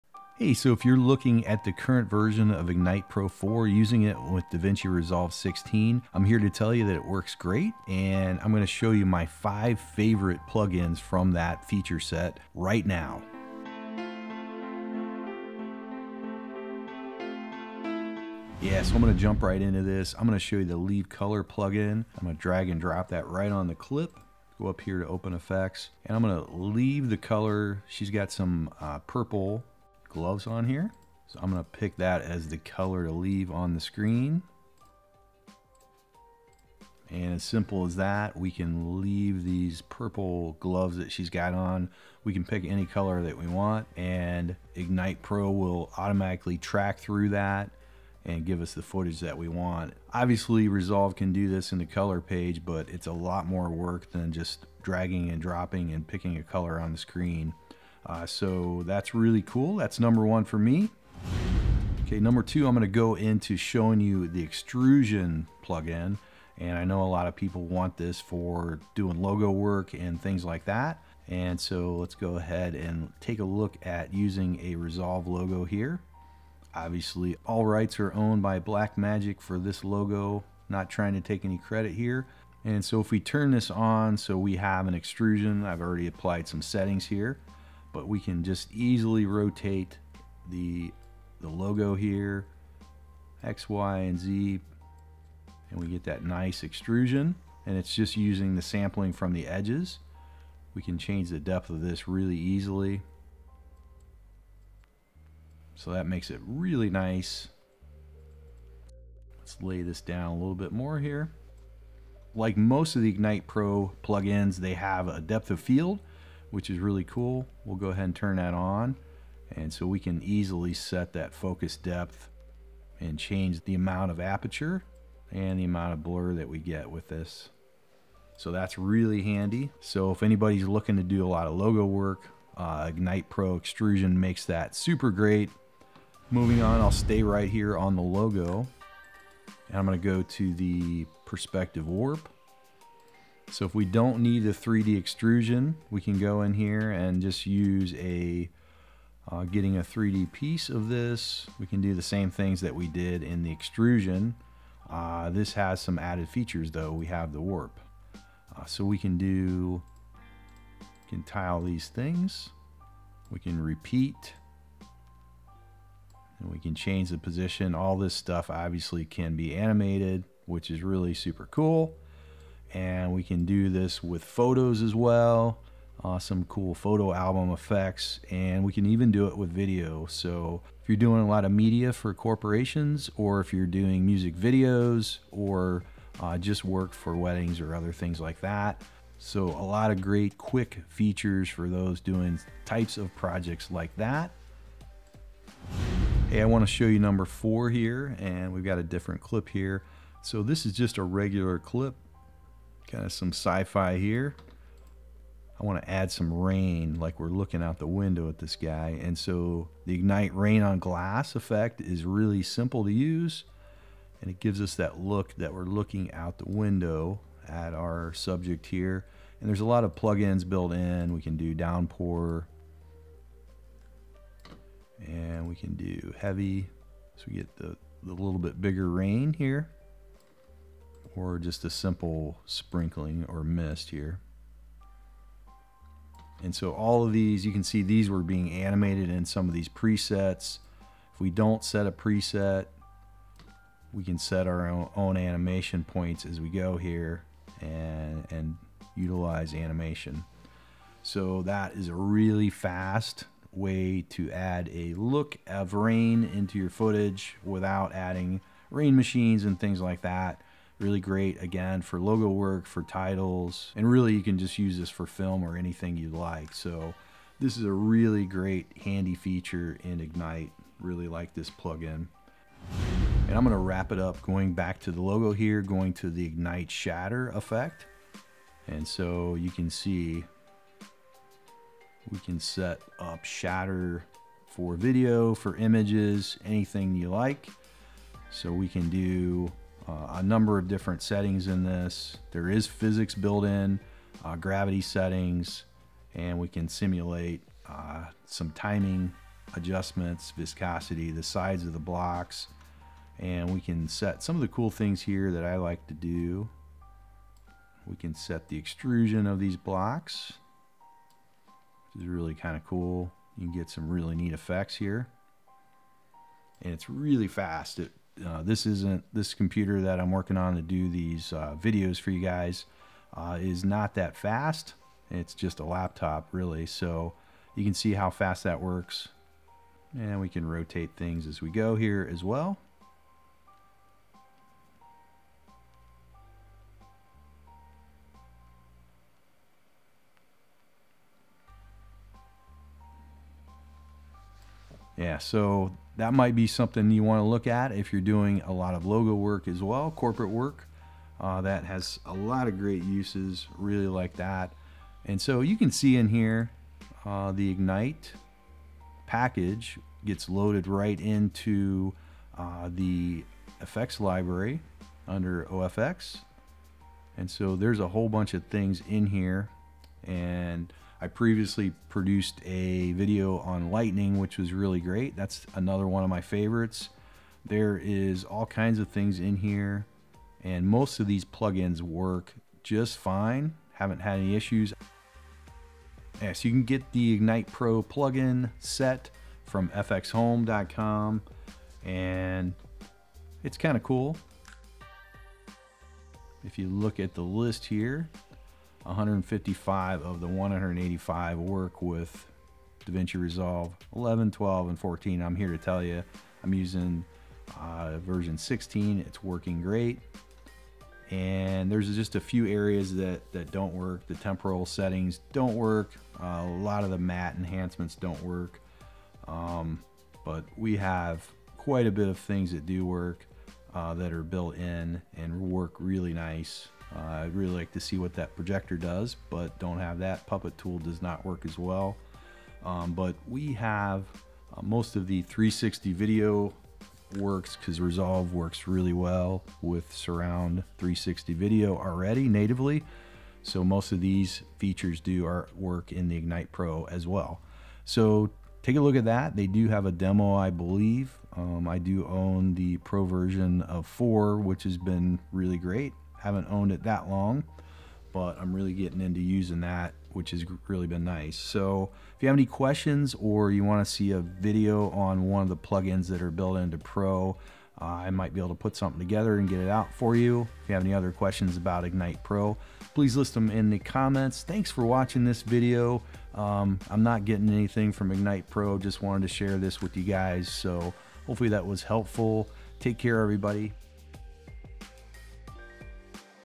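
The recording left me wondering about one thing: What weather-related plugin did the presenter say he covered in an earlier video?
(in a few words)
lightning.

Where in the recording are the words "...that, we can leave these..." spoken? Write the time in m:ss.
0:37.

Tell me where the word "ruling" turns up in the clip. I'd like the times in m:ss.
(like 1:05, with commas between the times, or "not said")
not said.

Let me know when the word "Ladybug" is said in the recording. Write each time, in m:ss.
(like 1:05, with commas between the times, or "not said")
not said.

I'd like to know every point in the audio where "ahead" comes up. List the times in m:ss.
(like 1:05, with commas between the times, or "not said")
1:12, 1:57.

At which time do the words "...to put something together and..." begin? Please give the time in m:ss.
7:48.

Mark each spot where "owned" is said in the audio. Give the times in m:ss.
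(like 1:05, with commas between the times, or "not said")
1:18, 7:36.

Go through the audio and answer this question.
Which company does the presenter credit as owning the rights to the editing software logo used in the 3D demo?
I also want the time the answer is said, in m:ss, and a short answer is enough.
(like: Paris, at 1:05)
Blackmagic, at 1:18.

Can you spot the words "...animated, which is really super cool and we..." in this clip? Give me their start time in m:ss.
2:49.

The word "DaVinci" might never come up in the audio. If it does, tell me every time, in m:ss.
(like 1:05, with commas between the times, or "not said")
0:04, 6:42.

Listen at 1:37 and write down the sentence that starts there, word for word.
And it's just using the sampling from the edges.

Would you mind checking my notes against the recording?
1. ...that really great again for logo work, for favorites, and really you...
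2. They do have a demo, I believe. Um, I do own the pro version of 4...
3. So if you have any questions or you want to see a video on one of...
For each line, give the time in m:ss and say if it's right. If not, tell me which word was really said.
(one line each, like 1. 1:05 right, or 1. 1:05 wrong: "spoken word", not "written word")
1. 4:20 wrong: "titles", not "favorites"
2. 7:29 right
3. 7:41 right.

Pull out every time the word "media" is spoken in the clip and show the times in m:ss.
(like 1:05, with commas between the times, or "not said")
3:01.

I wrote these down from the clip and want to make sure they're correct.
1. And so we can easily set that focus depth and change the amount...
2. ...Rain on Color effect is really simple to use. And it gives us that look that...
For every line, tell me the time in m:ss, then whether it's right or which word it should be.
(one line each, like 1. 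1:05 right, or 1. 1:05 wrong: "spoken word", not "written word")
1. 1:59 right
2. 3:30 wrong: "Glass", not "Color".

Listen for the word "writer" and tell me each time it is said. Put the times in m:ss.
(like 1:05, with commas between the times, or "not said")
not said.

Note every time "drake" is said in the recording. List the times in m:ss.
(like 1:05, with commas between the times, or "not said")
not said.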